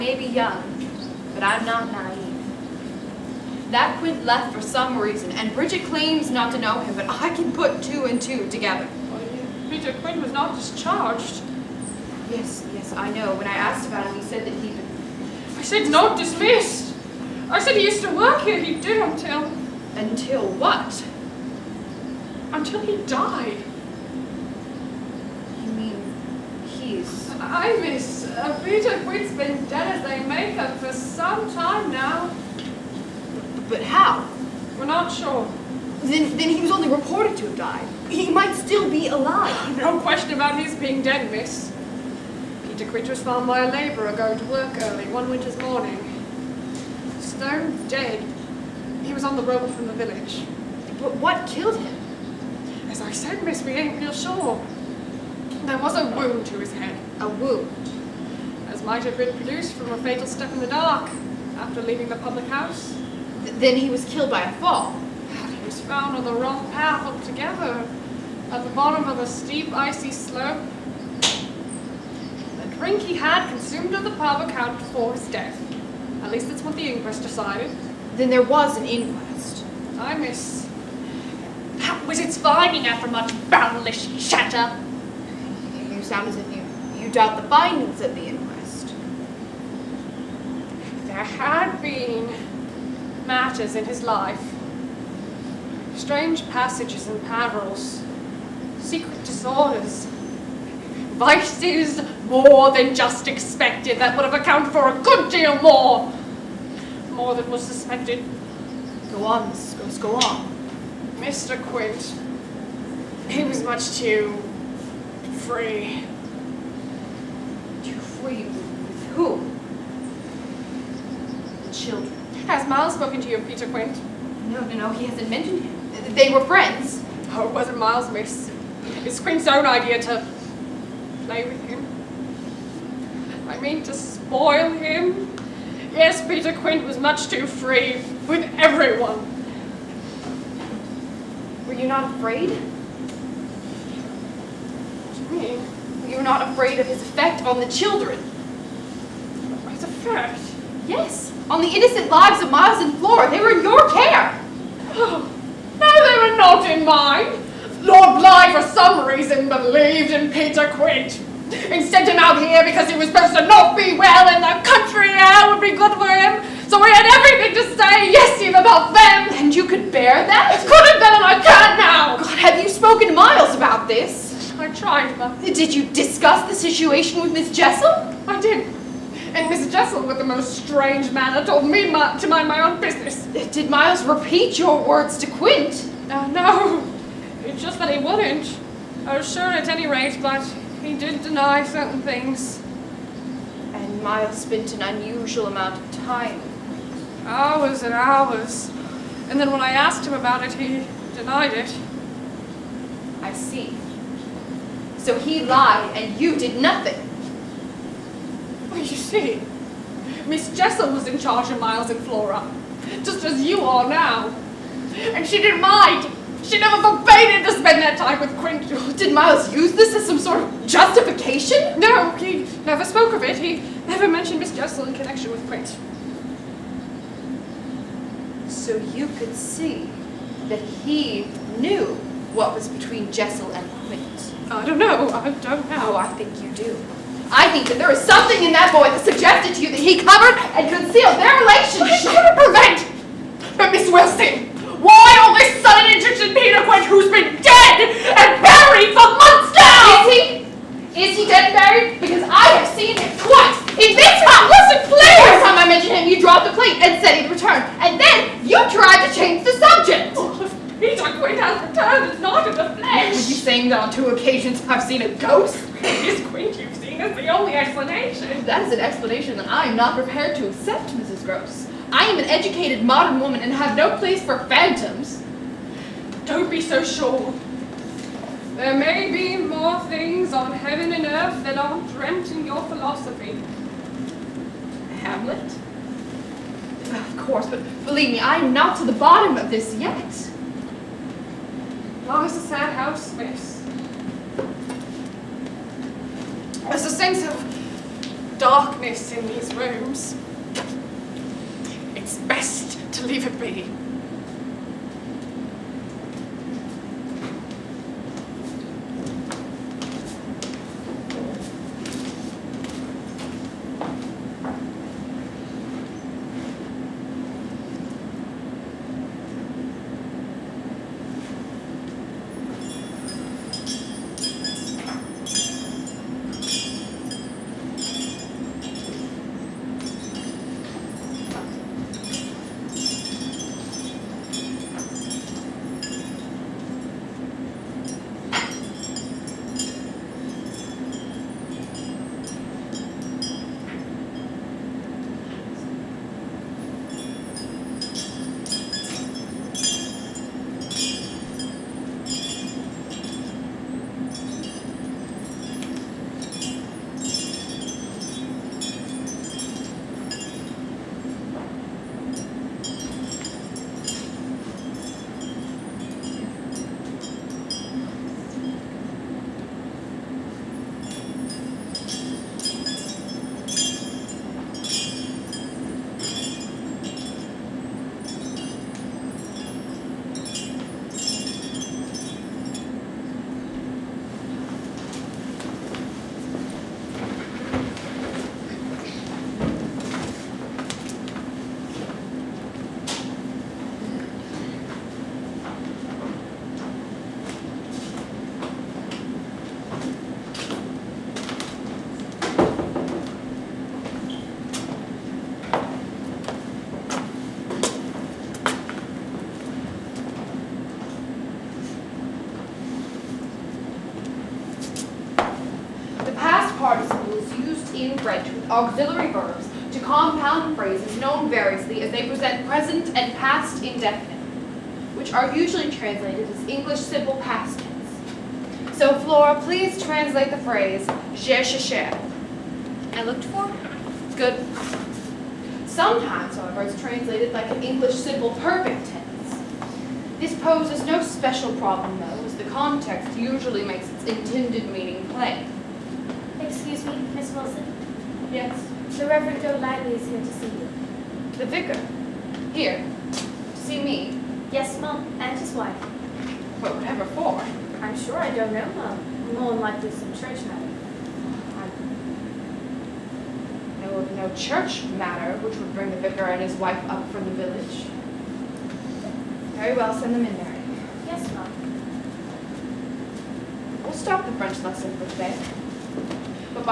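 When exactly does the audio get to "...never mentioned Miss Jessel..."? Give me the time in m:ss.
3:43.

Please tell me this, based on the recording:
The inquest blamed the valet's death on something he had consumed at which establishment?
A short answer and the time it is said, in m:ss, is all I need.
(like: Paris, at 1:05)
The pub, at 1:14.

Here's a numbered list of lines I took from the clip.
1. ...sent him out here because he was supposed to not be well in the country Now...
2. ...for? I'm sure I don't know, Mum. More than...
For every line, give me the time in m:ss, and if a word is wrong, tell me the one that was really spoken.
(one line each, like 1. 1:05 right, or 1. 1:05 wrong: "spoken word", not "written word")
1. 2:41 right
2. 7:37 right.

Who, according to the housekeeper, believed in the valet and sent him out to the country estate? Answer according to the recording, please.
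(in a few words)
Lord Bly.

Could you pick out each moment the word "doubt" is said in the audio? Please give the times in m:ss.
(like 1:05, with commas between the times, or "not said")
1:27.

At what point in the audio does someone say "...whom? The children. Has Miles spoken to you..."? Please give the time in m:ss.
1:59.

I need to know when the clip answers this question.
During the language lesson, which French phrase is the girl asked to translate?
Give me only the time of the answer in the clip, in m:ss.
7:11.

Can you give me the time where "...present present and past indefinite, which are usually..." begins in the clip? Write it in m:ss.
7:02.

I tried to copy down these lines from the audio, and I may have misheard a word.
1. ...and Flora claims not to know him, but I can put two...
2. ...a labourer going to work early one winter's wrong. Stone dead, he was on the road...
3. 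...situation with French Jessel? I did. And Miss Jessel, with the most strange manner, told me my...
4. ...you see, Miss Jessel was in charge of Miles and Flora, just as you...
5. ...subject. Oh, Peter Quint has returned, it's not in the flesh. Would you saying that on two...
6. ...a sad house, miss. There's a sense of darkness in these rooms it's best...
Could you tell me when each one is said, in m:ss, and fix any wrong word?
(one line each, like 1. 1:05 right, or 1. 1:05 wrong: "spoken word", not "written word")
1. 0:05 wrong: "Bridget", not "Flora"
2. 0:43 wrong: "morning", not "wrong"
3. 2:56 wrong: "Miss", not "French"
4. 3:28 right
5. 4:19 right
6. 4:52 right.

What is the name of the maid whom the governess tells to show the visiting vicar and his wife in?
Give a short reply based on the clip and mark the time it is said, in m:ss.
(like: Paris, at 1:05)
Mary, at 7:50.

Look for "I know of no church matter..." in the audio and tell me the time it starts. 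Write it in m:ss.
7:43.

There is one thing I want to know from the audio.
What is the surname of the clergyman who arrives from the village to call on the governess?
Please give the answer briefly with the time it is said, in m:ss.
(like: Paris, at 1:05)
Golightly, at 7:29.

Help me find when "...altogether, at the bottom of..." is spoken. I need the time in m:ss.
1:07.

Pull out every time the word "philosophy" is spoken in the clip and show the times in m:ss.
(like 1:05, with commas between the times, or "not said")
4:42.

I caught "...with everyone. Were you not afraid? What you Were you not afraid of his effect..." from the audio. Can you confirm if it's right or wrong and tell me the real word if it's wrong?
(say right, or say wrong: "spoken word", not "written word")
right.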